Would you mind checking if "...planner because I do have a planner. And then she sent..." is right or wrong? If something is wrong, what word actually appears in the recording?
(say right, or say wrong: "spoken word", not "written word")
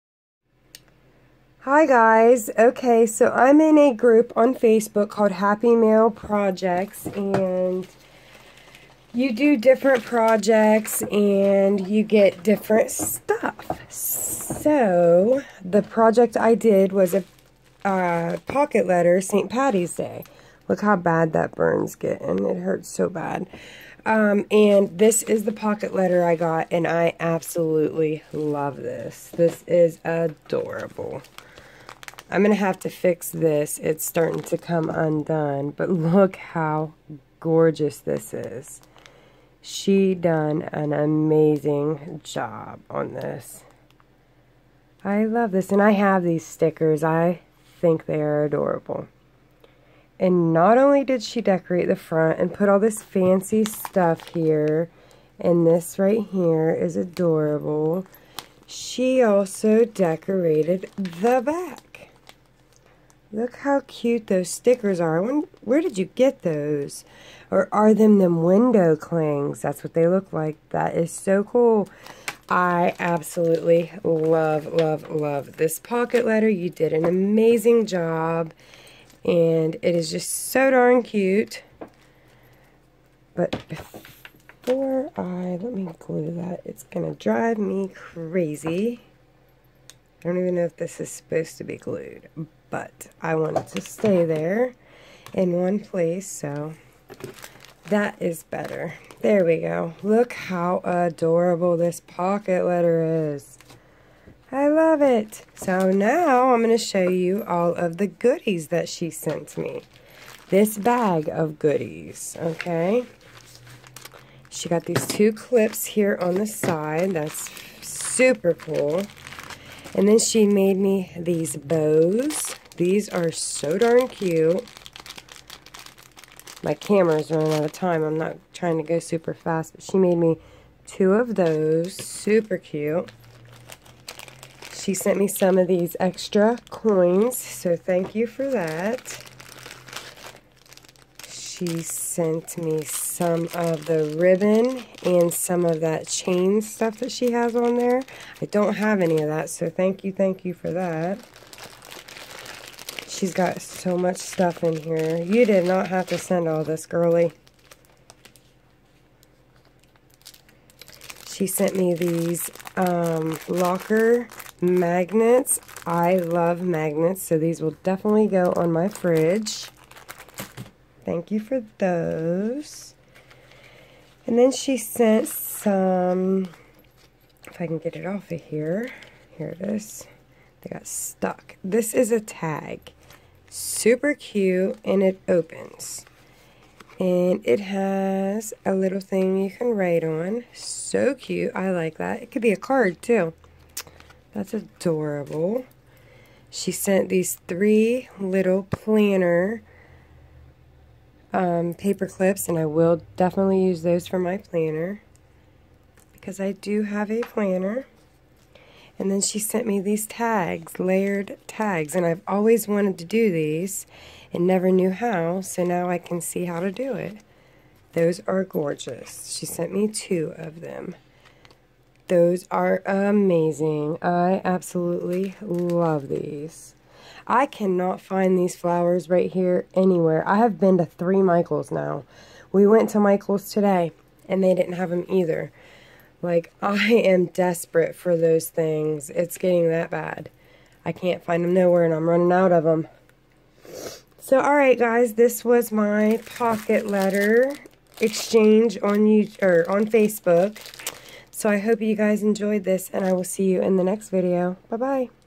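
right.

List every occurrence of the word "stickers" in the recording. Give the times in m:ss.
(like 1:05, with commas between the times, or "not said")
0:46, 1:04.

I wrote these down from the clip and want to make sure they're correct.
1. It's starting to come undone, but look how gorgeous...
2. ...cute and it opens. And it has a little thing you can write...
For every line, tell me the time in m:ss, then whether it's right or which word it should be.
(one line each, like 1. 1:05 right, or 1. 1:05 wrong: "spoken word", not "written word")
1. 0:33 right
2. 3:04 right.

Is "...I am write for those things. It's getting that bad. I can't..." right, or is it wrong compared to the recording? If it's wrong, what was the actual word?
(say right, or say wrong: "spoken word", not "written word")
wrong: "desperate", not "write".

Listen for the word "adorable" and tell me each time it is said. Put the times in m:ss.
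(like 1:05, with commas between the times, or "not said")
0:30, 0:48, 0:56, 1:40, 3:14.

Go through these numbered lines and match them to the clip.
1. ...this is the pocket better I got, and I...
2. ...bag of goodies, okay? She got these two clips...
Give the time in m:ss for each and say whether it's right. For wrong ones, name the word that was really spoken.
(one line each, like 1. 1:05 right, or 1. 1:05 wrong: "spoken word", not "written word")
1. 0:24 wrong: "letter", not "better"
2. 1:50 right.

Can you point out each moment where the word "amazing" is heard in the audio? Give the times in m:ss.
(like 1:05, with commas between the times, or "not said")
0:40, 1:17, 3:42.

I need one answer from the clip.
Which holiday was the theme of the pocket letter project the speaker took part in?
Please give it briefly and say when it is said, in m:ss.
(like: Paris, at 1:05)
St. Patty's Day, at 0:19.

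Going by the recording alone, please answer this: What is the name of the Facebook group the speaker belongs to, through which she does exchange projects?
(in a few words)
Happy Mail Projects.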